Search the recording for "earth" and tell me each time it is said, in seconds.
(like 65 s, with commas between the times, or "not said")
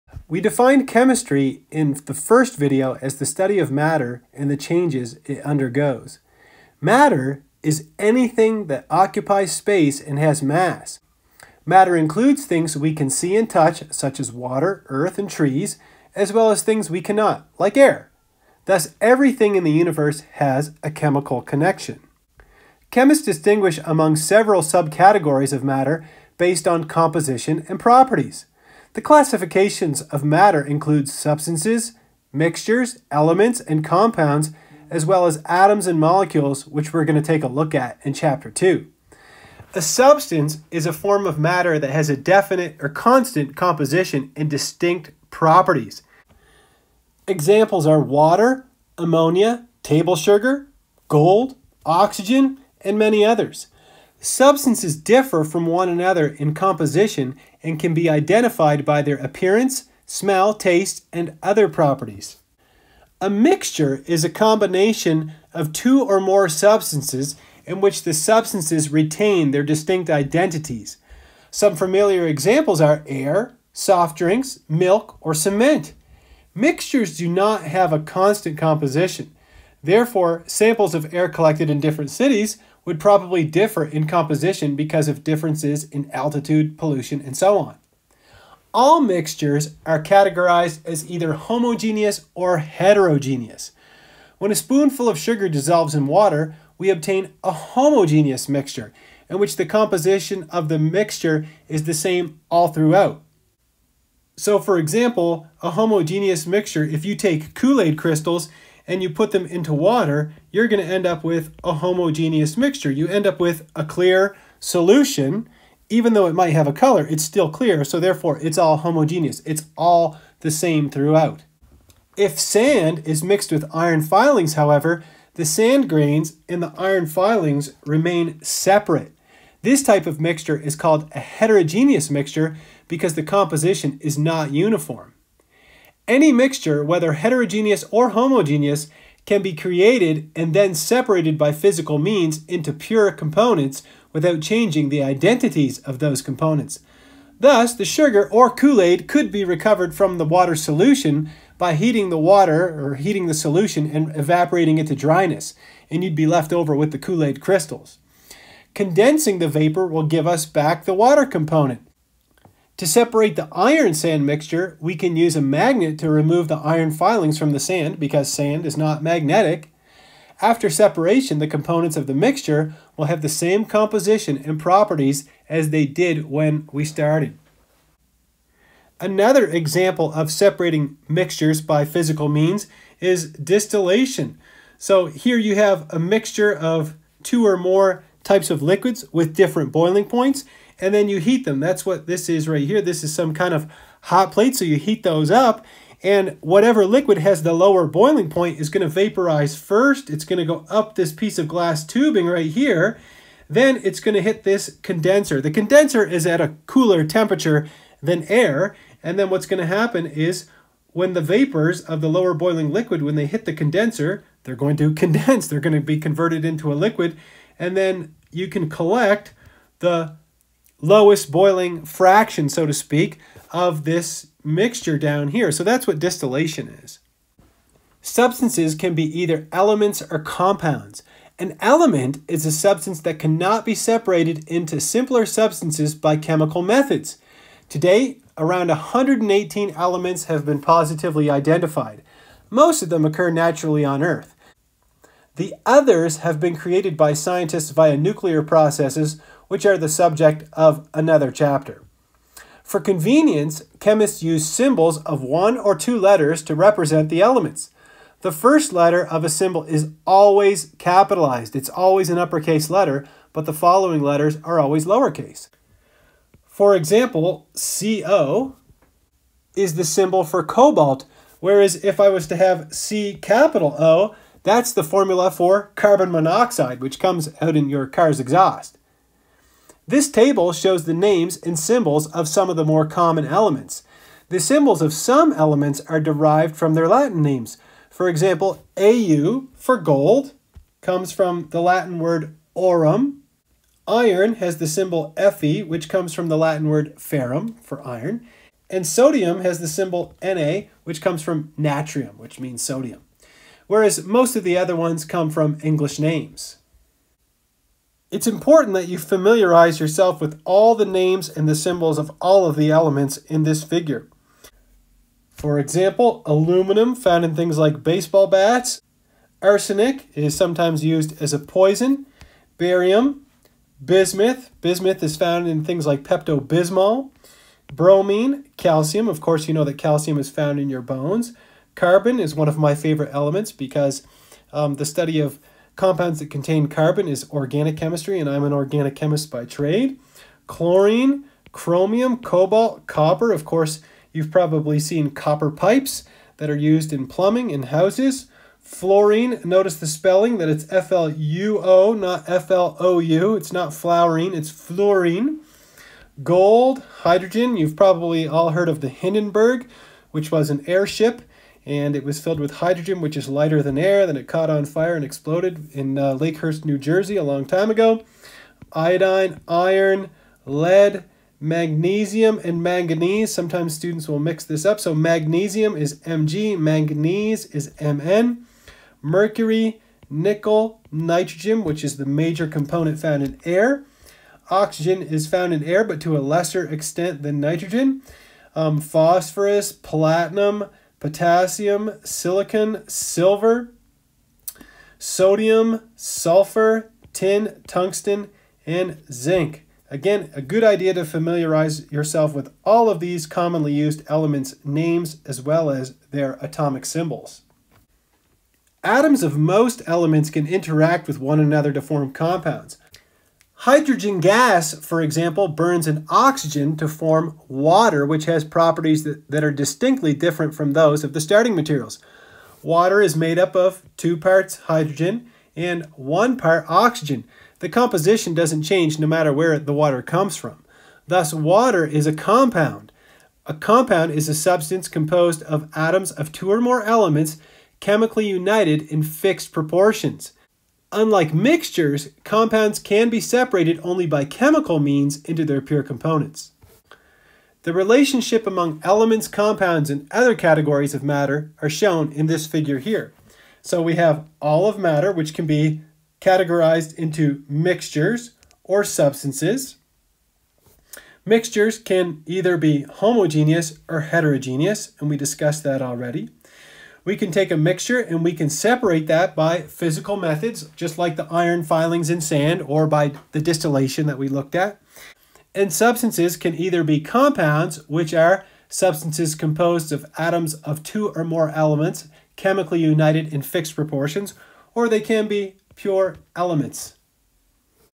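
14 s, 244 s.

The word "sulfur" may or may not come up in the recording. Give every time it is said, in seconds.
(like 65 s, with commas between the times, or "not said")
395 s.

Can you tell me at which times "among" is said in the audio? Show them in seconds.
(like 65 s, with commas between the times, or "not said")
23 s, 448 s.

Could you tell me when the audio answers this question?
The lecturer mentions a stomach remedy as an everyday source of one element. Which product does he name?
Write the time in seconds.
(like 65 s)
326 s.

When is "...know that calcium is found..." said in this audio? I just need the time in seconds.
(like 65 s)
329 s.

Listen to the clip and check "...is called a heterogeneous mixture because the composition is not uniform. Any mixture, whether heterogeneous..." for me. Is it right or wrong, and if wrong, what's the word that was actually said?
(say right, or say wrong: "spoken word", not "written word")
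right.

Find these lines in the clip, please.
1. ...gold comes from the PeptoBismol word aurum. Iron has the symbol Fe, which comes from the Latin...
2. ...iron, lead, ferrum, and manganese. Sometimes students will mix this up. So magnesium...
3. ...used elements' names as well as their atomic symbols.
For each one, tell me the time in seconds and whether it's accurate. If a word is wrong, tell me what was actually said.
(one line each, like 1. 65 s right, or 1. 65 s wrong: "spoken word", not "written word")
1. 289 s wrong: "Latin", not "PeptoBismol"
2. 369 s wrong: "magnesium", not "ferrum"
3. 403 s right.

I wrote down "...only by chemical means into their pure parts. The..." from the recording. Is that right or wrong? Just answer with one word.
wrong.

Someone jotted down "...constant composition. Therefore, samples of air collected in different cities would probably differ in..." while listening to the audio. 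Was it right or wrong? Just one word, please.
right.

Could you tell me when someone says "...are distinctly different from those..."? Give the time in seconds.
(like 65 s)
419 s.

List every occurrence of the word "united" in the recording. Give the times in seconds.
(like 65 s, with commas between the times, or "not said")
438 s, 482 s.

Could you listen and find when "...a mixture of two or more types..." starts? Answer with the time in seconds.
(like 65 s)
185 s.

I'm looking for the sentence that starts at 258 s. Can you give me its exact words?
The first letter of a symbol is always capitalized.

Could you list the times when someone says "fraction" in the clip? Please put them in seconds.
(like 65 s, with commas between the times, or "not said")
221 s.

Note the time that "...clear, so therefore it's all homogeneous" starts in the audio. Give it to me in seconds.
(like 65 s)
117 s.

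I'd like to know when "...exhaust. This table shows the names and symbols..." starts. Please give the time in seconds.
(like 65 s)
278 s.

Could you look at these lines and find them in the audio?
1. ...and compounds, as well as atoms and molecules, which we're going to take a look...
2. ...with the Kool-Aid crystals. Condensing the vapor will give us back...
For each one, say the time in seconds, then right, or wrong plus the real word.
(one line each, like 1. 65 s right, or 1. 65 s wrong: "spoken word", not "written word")
1. 33 s right
2. 156 s right.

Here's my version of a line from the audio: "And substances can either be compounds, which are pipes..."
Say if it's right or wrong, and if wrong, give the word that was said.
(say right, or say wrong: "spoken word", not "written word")
wrong: "substances", not "pipes".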